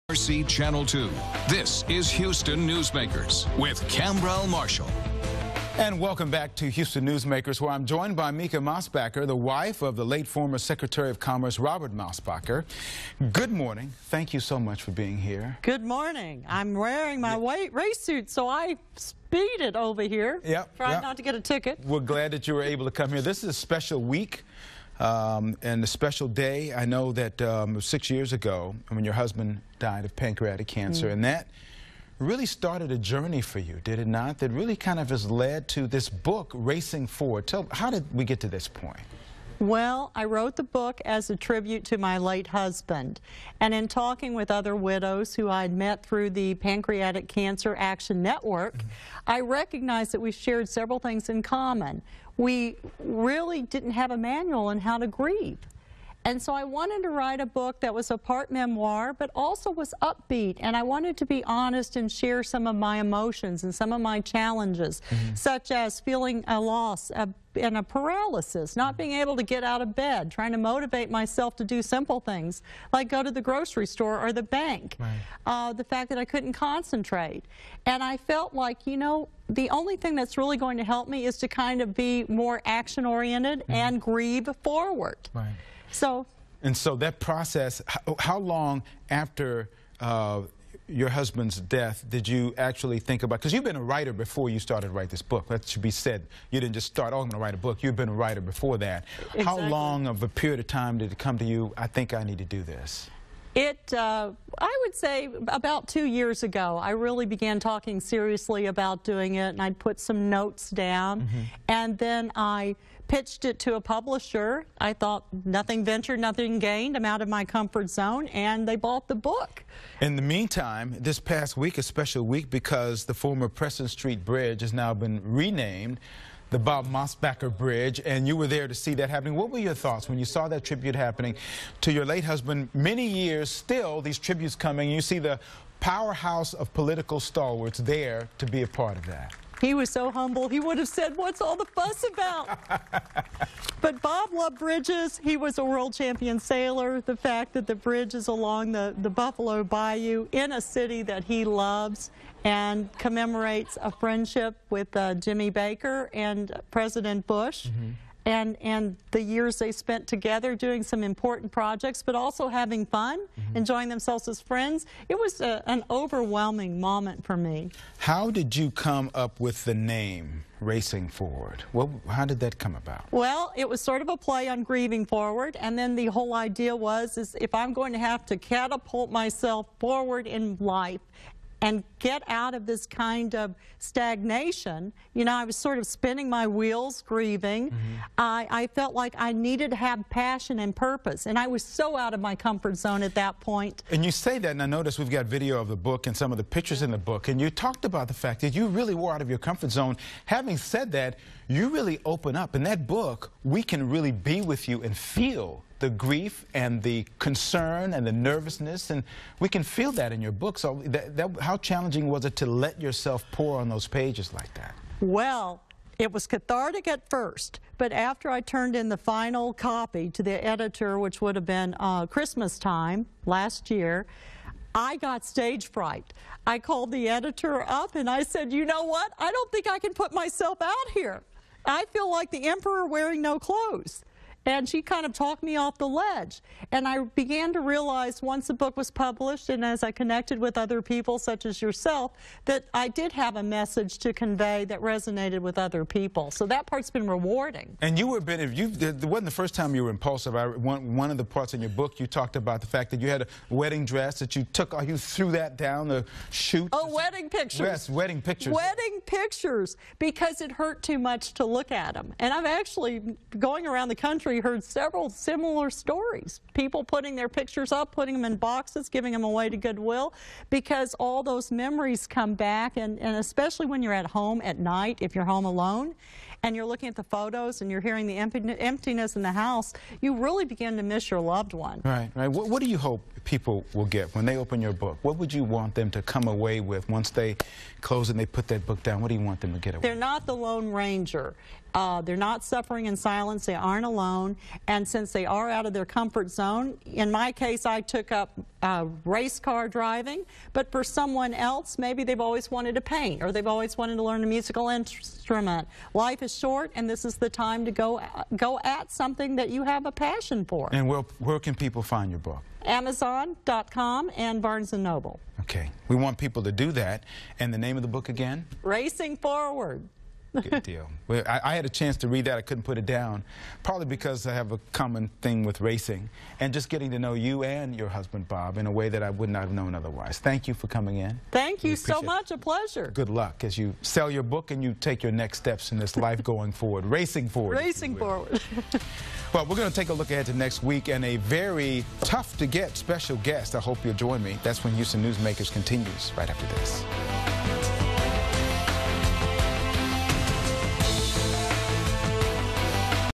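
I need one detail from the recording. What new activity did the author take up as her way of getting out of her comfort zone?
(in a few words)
race car driving.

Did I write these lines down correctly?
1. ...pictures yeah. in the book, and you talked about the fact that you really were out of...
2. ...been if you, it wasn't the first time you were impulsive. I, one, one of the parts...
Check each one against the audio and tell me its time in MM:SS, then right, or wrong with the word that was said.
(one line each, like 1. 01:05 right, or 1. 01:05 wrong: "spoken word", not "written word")
1. 03:16 right
2. 04:08 right.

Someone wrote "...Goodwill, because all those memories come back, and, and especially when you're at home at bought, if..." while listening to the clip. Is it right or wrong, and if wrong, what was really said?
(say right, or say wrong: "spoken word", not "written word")
wrong: "night", not "bought".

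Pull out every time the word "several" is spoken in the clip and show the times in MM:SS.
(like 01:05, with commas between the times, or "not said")
00:50, 04:24.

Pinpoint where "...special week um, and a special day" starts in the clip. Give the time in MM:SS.
00:23.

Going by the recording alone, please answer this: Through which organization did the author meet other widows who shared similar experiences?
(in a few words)
Pancreatic Cancer Action Network.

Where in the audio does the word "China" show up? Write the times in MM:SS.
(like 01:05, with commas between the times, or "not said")
not said.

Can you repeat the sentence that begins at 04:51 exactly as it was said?
Uh, they're not suffering in silence.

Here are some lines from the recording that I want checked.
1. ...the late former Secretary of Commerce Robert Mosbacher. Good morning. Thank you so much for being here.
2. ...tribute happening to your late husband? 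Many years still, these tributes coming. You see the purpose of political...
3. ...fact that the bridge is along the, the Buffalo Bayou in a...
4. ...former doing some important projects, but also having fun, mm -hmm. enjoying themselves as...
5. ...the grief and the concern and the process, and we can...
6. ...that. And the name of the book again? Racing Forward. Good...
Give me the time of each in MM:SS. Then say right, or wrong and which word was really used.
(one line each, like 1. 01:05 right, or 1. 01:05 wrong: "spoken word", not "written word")
1. 00:09 right
2. 02:10 wrong: "powerhouse", not "purpose"
3. 02:27 right
4. 02:40 wrong: "together", not "former"
5. 03:25 wrong: "nervousness", not "process"
6. 05:16 right.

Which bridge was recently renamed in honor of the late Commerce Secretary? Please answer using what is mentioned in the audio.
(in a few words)
Preston Street Bridge.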